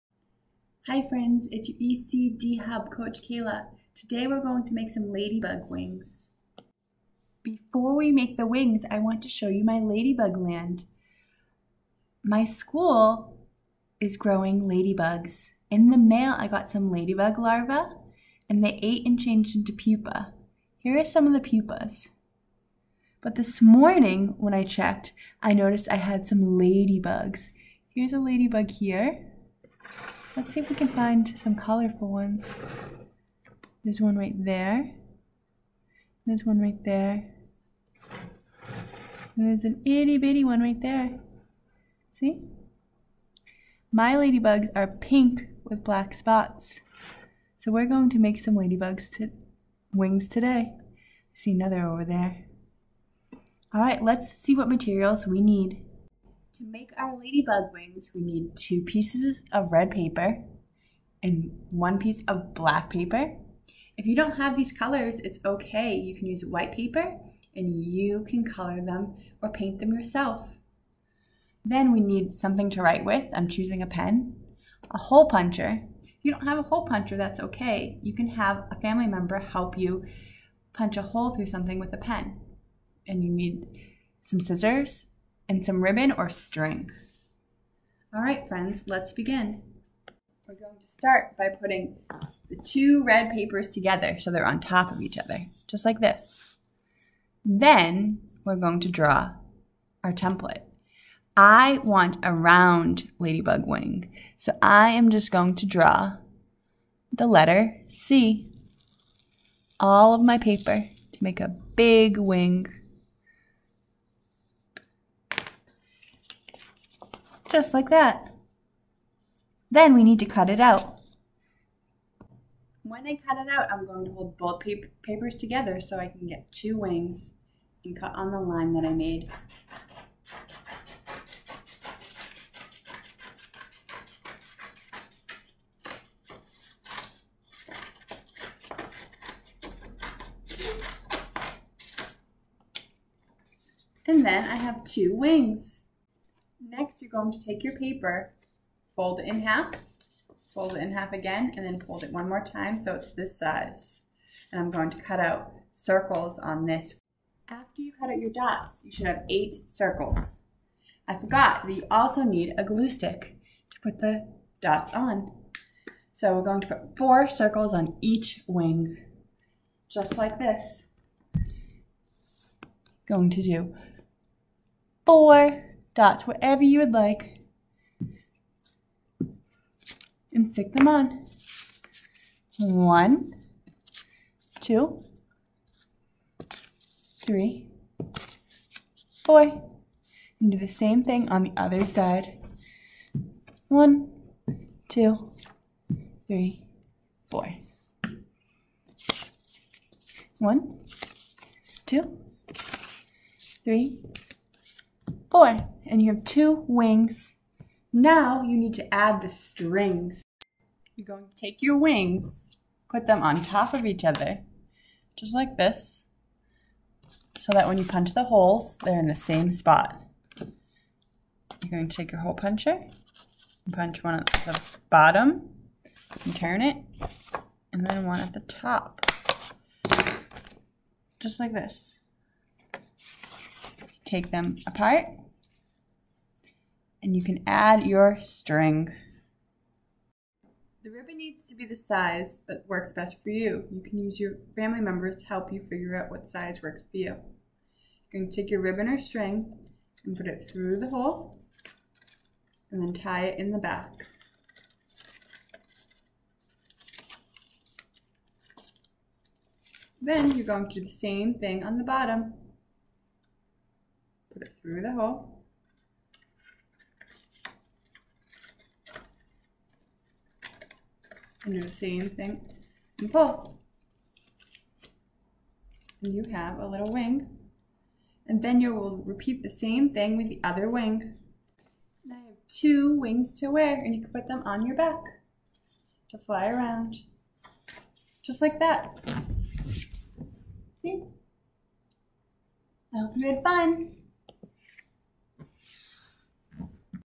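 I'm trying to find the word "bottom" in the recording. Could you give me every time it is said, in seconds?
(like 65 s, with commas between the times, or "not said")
224 s, 261 s.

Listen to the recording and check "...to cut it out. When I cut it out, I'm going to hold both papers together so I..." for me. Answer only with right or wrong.
right.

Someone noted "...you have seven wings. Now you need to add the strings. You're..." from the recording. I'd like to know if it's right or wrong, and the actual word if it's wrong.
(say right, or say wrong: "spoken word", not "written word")
wrong: "two", not "seven".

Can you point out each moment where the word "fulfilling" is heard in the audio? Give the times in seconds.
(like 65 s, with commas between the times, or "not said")
not said.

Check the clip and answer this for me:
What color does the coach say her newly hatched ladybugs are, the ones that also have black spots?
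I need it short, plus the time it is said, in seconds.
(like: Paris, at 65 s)
pink, at 44 s.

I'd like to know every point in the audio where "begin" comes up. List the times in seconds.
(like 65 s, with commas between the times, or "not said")
89 s.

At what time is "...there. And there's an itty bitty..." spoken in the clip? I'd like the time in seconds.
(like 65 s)
36 s.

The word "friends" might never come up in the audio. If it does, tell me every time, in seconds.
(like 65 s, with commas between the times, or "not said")
1 s, 88 s.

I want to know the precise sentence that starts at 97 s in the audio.
Then we're going to draw our template.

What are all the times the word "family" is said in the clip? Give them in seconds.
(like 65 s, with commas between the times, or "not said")
78 s, 244 s.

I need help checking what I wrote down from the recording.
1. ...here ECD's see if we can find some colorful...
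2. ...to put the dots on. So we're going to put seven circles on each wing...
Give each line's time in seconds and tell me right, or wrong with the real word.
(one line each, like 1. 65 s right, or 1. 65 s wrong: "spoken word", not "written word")
1. 28 s wrong: "Let", not "ECD"
2. 163 s wrong: "four", not "seven".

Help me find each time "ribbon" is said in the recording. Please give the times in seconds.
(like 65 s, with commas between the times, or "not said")
85 s, 240 s, 248 s.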